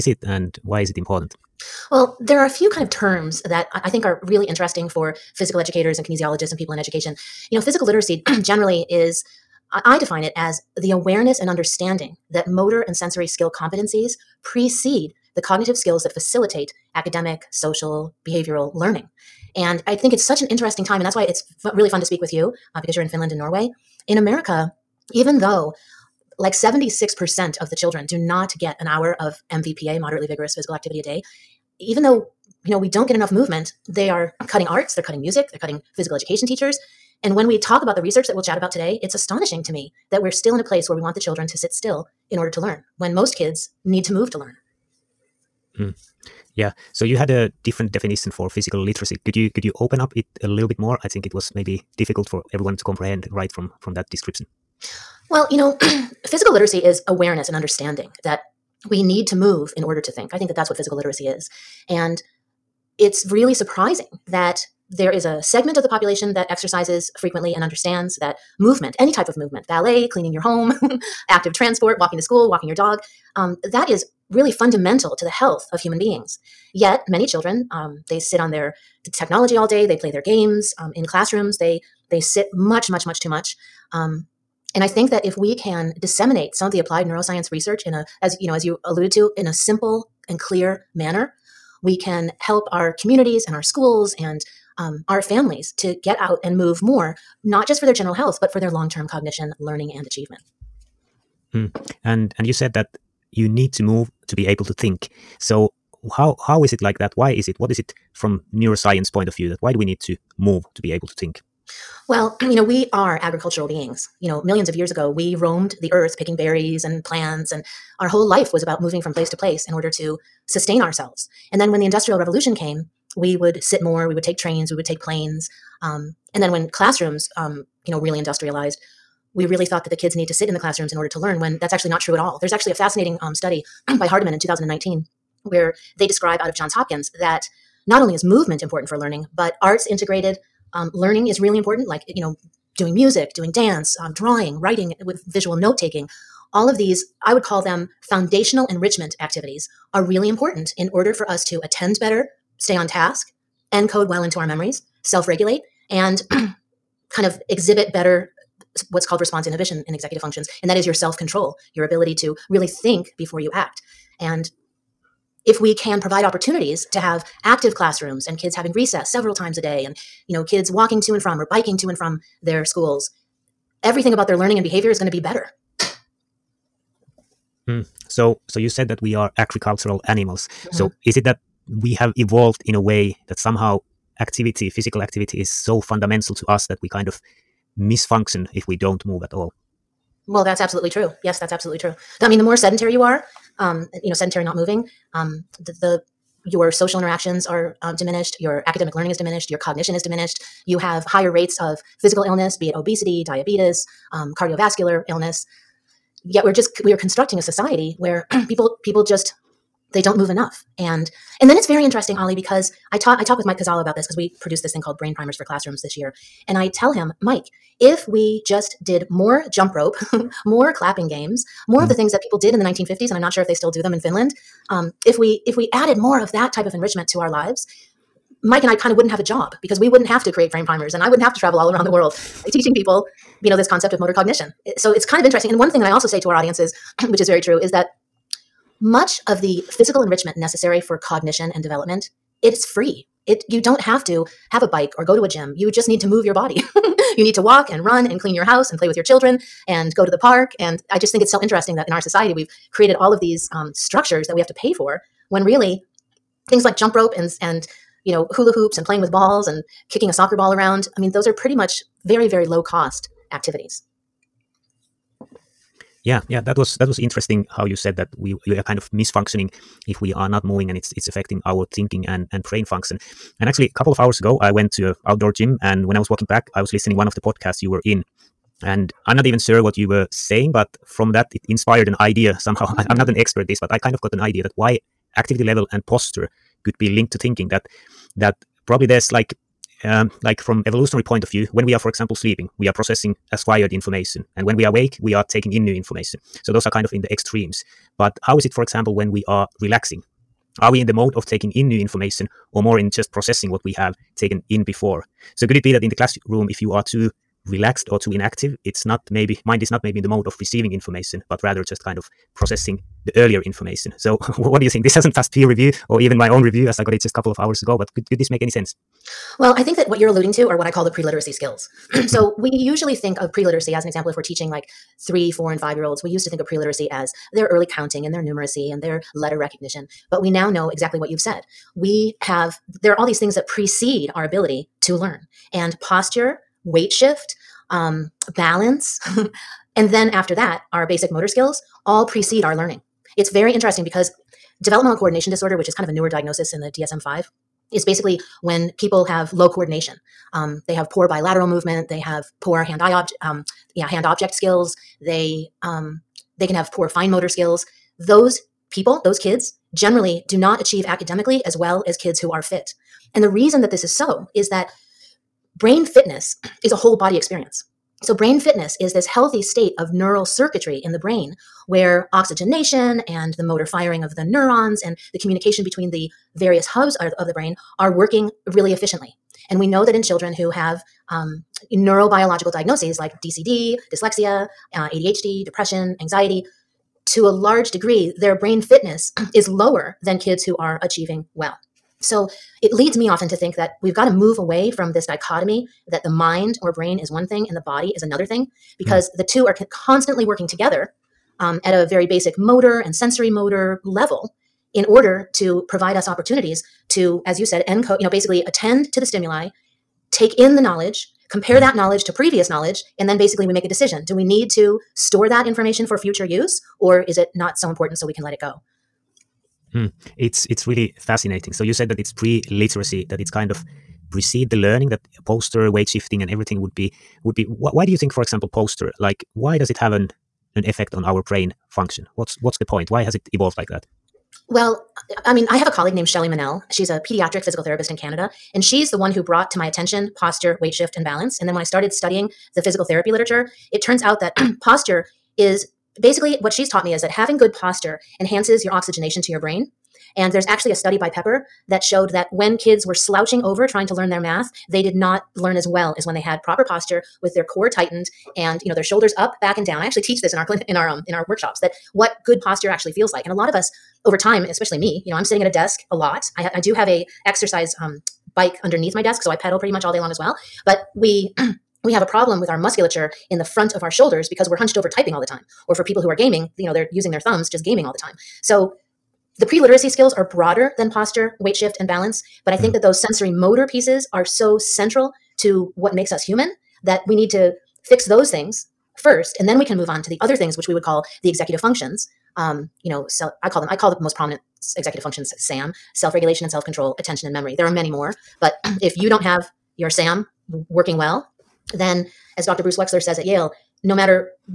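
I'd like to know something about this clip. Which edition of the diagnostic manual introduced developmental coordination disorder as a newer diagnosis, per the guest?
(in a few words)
DSM 5.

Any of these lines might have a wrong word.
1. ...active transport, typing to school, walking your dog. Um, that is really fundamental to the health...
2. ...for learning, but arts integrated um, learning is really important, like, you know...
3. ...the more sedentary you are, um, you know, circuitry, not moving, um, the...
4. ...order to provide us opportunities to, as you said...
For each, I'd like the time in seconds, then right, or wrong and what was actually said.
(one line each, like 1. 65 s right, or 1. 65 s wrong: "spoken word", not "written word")
1. 71 s wrong: "walking", not "typing"
2. 138 s right
3. 192 s wrong: "sedentary", not "circuitry"
4. 404 s right.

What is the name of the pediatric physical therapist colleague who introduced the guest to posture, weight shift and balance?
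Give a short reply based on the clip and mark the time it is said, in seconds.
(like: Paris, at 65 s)
Shelly Manell, at 436 s.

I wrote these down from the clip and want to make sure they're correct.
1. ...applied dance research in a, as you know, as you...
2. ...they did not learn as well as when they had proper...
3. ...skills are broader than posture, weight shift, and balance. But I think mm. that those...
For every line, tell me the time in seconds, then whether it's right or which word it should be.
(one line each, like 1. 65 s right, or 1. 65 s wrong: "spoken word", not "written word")
1. 86 s wrong: "neuroscience", not "dance"
2. 454 s right
3. 479 s right.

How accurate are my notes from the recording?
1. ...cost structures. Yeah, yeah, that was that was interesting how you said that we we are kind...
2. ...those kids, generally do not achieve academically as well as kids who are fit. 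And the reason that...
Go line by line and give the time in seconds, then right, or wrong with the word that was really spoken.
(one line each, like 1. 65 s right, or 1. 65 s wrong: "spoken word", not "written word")
1. 262 s wrong: "activities", not "structures"
2. 359 s right.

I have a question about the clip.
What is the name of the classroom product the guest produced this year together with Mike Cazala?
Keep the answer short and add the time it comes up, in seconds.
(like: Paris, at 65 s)
Brain Primers for Classrooms, at 214 s.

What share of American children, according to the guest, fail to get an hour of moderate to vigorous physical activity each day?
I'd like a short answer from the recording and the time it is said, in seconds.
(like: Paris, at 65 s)
76%, at 26 s.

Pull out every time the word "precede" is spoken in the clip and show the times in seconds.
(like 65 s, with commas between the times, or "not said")
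14 s, 333 s, 342 s, 424 s.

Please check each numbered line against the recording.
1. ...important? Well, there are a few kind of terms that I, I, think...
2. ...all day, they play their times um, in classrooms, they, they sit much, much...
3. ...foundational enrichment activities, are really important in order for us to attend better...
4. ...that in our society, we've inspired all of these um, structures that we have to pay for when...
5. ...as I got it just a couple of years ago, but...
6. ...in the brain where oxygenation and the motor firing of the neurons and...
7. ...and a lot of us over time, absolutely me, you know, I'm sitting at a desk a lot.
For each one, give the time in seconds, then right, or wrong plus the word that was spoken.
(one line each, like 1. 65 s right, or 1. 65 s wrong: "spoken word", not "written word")
1. 0 s right
2. 79 s wrong: "games", not "times"
3. 148 s right
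4. 251 s wrong: "created", not "inspired"
5. 316 s wrong: "hours", not "years"
6. 370 s right
7. 463 s wrong: "especially", not "absolutely".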